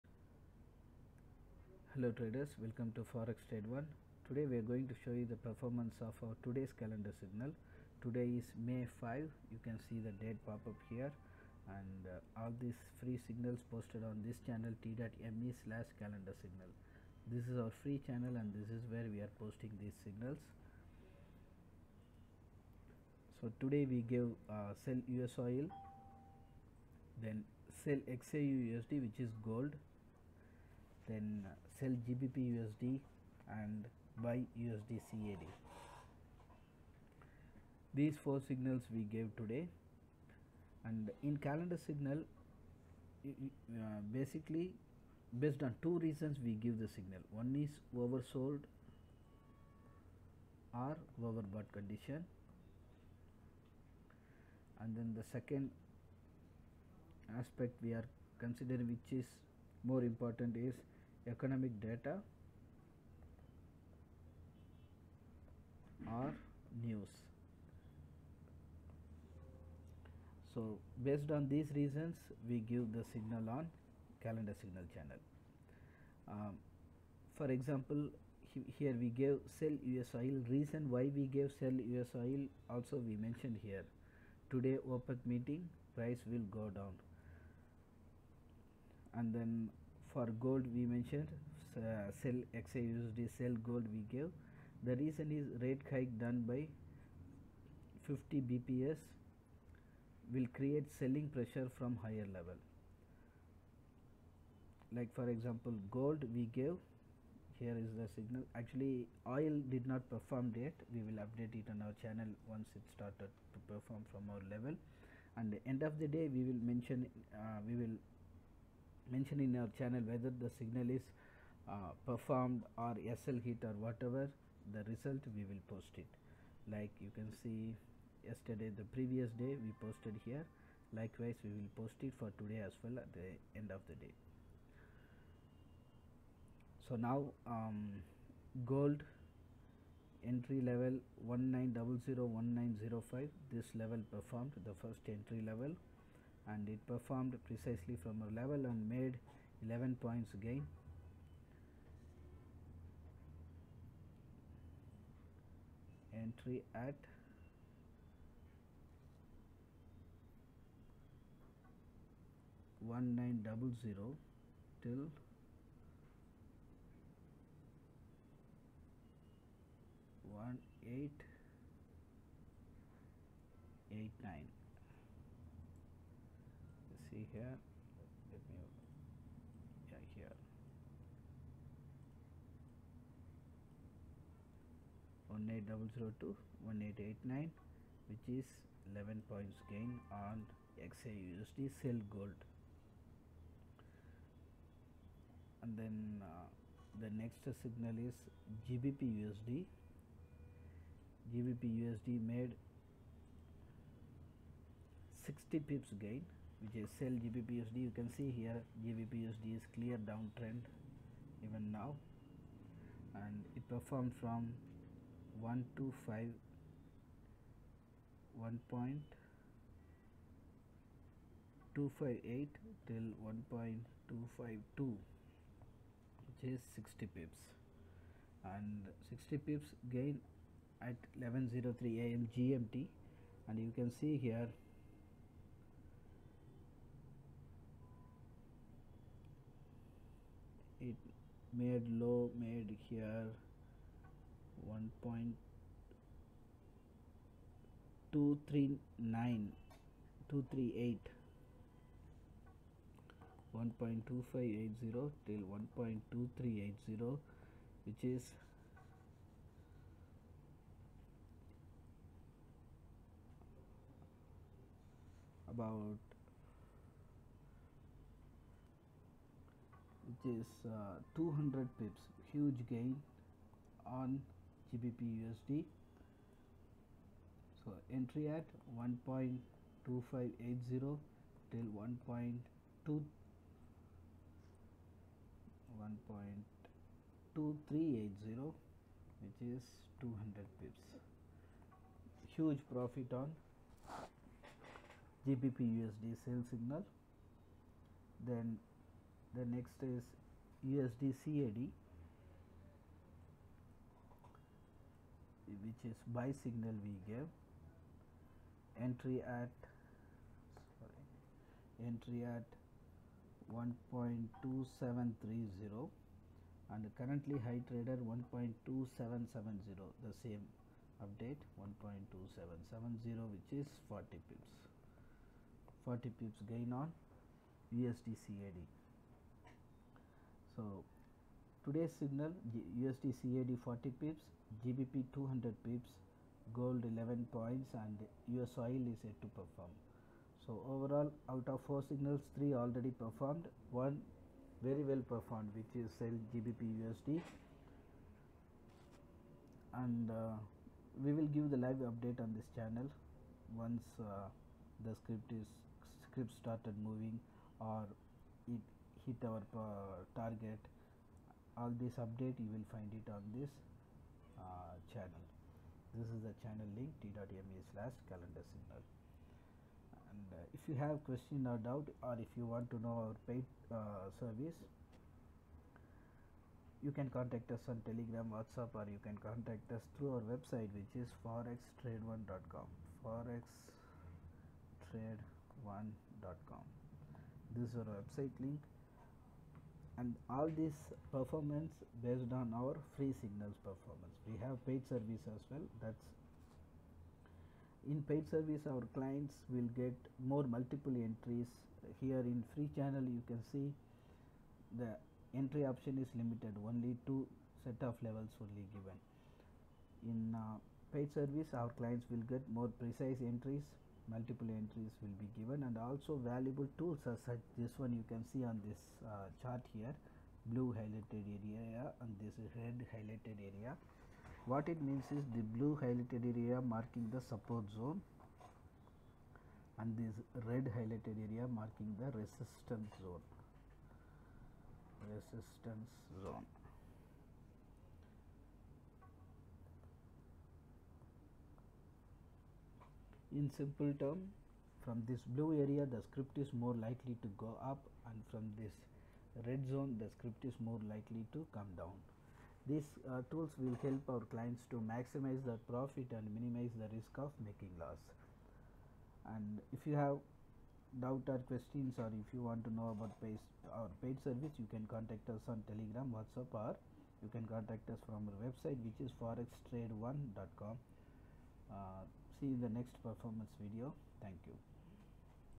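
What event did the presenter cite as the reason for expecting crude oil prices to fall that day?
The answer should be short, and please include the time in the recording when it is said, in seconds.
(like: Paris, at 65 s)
OPEC meeting, at 84 s.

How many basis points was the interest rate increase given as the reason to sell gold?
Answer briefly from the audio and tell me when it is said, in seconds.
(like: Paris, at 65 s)
50, at 98 s.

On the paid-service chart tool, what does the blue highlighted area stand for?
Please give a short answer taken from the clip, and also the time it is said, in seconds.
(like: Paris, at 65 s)
support zone, at 427 s.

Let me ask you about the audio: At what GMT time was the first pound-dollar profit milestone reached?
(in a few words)
11:03 am.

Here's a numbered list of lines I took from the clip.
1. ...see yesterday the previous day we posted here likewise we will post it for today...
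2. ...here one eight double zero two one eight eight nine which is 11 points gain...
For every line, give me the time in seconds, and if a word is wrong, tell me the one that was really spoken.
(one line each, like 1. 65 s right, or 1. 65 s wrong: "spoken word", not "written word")
1. 127 s right
2. 180 s right.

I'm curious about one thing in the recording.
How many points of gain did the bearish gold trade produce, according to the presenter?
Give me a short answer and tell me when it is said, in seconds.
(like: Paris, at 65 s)
11 points, at 149 s.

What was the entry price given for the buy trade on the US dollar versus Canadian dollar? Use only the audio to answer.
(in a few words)
1.2730.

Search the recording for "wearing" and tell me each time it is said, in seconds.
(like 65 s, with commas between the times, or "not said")
not said.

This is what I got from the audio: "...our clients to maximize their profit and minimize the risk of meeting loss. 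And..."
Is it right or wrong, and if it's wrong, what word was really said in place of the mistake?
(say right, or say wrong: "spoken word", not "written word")
wrong: "making", not "meeting".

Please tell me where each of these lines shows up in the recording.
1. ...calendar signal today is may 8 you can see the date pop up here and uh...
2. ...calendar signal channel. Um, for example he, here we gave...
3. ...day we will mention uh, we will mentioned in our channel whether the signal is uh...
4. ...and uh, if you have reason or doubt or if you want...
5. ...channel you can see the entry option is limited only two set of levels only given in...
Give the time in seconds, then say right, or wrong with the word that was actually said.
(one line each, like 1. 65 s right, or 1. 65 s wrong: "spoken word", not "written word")
1. 6 s wrong: "5", not "8"
2. 74 s right
3. 116 s right
4. 368 s wrong: "question", not "reason"
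5. 402 s right.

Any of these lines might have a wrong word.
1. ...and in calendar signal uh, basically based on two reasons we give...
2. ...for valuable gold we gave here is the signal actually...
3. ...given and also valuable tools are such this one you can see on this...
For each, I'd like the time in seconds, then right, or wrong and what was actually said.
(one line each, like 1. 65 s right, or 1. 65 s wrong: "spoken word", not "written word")
1. 40 s right
2. 105 s wrong: "example", not "valuable"
3. 415 s right.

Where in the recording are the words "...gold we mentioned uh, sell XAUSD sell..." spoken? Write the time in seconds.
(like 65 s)
90 s.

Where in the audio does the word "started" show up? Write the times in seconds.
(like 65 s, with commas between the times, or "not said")
112 s, 356 s.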